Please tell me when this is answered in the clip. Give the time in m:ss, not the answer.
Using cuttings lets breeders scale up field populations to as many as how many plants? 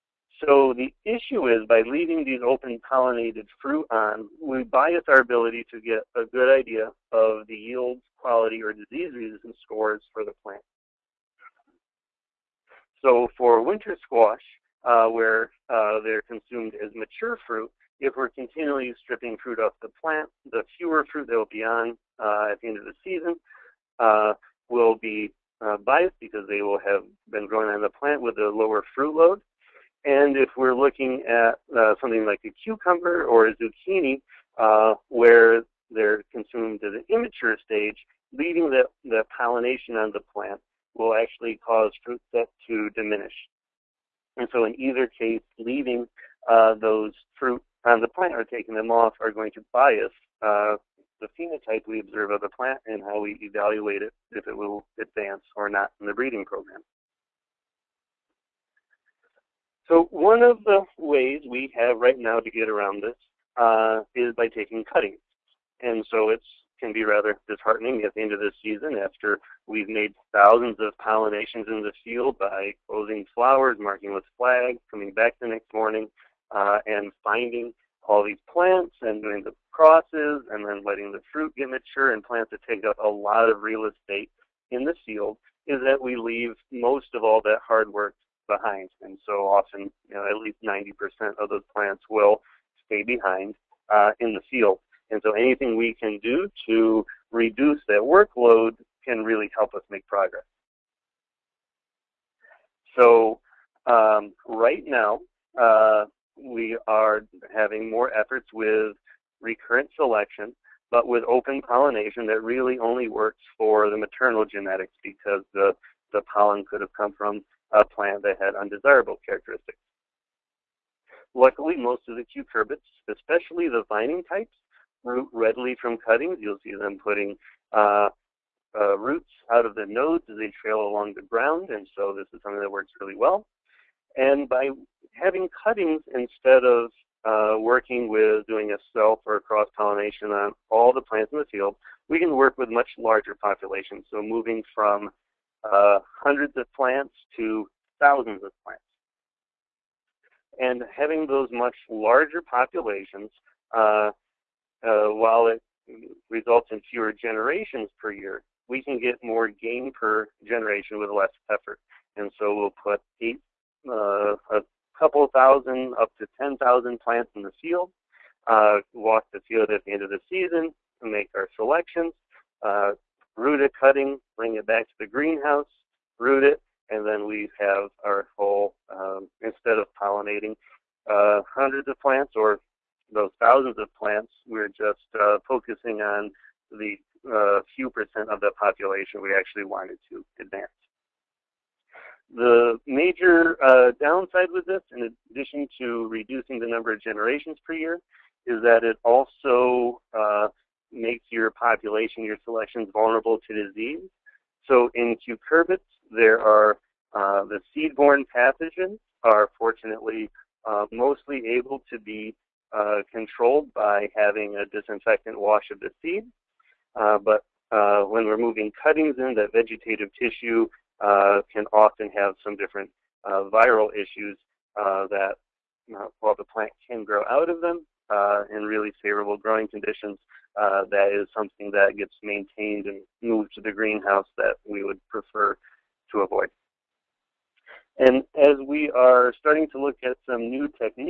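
2:46.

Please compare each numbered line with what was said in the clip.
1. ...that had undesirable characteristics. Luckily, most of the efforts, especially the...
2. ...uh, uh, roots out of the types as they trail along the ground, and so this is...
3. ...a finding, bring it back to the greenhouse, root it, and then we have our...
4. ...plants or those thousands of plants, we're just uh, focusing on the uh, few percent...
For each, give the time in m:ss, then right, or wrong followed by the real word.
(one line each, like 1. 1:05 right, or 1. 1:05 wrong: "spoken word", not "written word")
1. 1:58 wrong: "cucurbits", not "efforts"
2. 2:07 wrong: "nodes", not "types"
3. 2:53 wrong: "cutting", not "finding"
4. 3:01 right.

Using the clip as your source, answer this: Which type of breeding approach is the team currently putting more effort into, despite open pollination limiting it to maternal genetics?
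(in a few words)
recurrent selection.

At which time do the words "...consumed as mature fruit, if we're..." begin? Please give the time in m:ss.
0:16.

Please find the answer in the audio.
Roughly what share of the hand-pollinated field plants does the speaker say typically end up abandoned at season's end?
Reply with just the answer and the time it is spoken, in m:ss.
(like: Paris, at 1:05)
at least 90%, at 1:30.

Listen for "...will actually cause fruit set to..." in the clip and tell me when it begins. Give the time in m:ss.
0:40.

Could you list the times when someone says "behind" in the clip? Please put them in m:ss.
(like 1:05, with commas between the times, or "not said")
1:28, 1:33.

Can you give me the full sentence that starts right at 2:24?
So moving from uh, hundreds of plants to thousands of plants.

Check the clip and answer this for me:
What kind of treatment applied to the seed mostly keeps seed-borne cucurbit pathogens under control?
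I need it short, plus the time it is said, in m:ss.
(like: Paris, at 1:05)
disinfectant wash, at 3:34.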